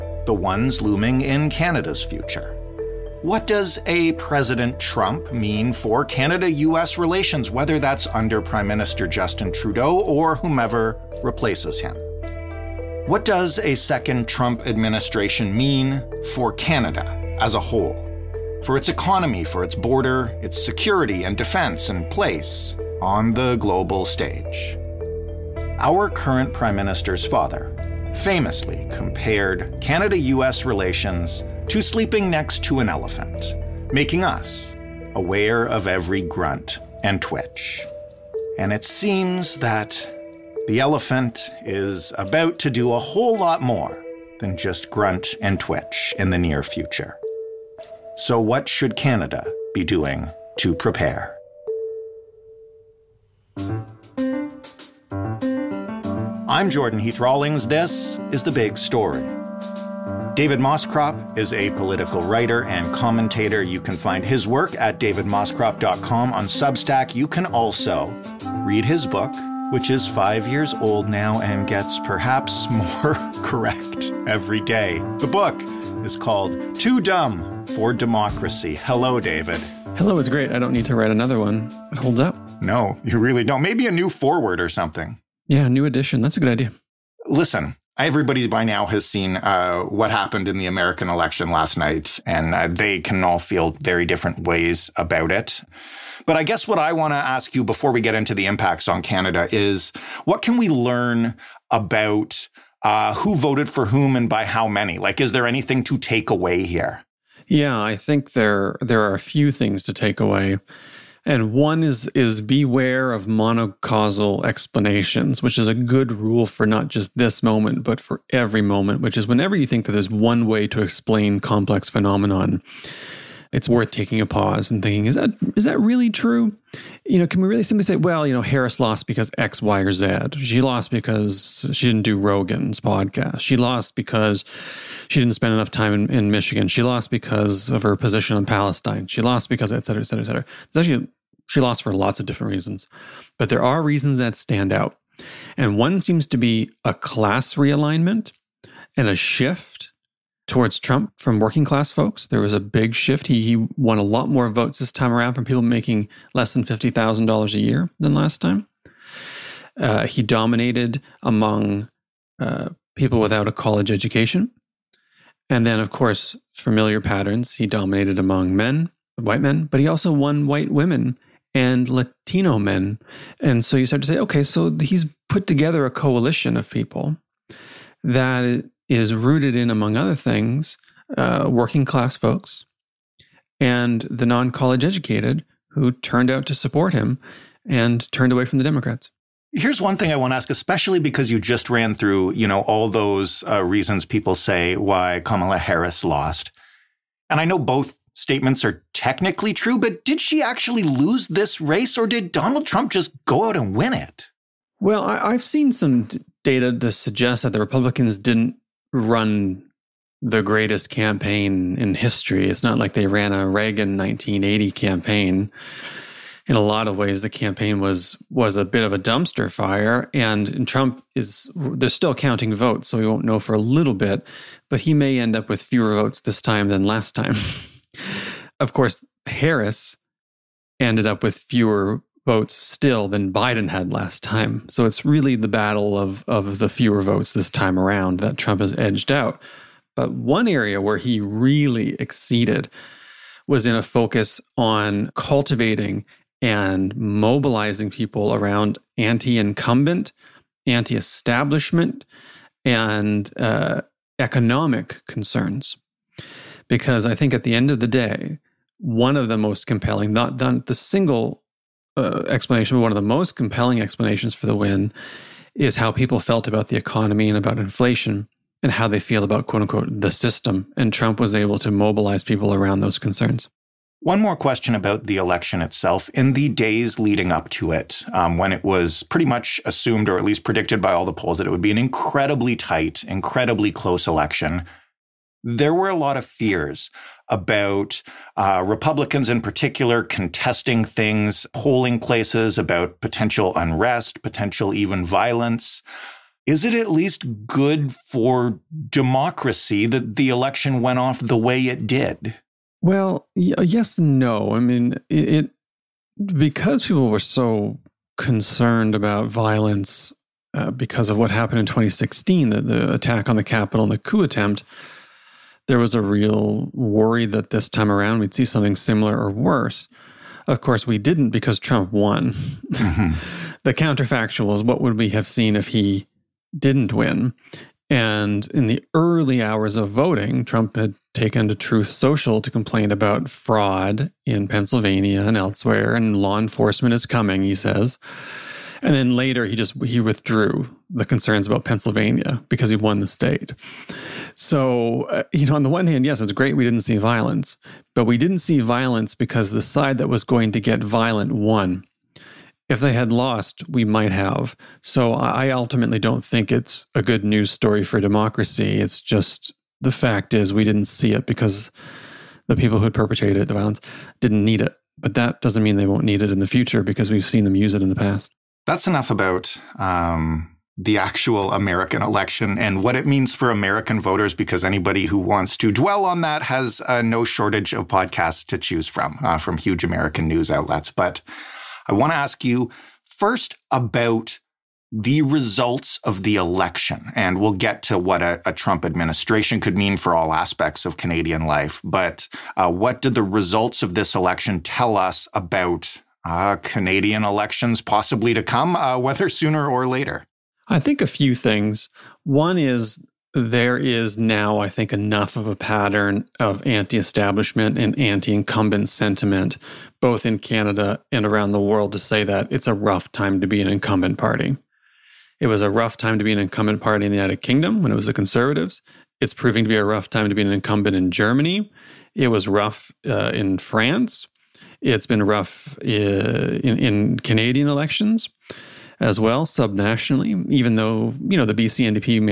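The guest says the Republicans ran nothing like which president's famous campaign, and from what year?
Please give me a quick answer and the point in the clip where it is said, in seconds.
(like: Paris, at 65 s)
Reagan 1980, at 213 s.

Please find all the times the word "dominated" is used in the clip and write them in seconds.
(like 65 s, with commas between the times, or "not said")
160 s, 167 s.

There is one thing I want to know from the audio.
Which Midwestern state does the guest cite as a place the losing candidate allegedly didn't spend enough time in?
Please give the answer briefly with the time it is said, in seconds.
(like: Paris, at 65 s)
Michigan, at 136 s.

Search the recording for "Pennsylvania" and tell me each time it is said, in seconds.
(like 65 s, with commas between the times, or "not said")
334 s, 341 s.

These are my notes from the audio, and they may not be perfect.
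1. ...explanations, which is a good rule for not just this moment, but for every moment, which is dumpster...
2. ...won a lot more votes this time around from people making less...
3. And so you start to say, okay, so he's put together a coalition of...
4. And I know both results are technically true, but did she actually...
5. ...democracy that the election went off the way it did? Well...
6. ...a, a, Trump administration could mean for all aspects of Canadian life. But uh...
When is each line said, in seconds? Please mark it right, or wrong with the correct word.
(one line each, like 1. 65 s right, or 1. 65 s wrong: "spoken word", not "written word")
1. 114 s wrong: "whenever", not "dumpster"
2. 153 s right
3. 173 s right
4. 197 s wrong: "statements", not "results"
5. 298 s right
6. 388 s right.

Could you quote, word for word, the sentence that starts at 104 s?
Like, is there anything to take away here?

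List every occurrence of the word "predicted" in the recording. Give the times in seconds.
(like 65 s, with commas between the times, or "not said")
280 s.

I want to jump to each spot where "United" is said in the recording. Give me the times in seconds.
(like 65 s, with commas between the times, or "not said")
417 s.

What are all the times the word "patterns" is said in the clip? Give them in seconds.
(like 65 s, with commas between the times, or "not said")
167 s, 405 s.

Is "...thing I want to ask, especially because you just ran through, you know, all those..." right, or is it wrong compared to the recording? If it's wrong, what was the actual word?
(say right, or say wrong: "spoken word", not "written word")
right.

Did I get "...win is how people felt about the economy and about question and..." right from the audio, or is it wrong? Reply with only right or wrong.
wrong.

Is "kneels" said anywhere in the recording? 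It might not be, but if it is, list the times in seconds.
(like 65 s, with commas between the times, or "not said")
not said.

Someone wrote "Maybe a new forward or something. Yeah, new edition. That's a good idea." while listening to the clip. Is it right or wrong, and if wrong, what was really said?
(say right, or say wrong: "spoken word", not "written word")
right.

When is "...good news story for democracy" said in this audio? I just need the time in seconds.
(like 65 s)
357 s.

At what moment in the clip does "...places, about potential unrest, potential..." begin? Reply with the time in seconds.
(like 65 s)
291 s.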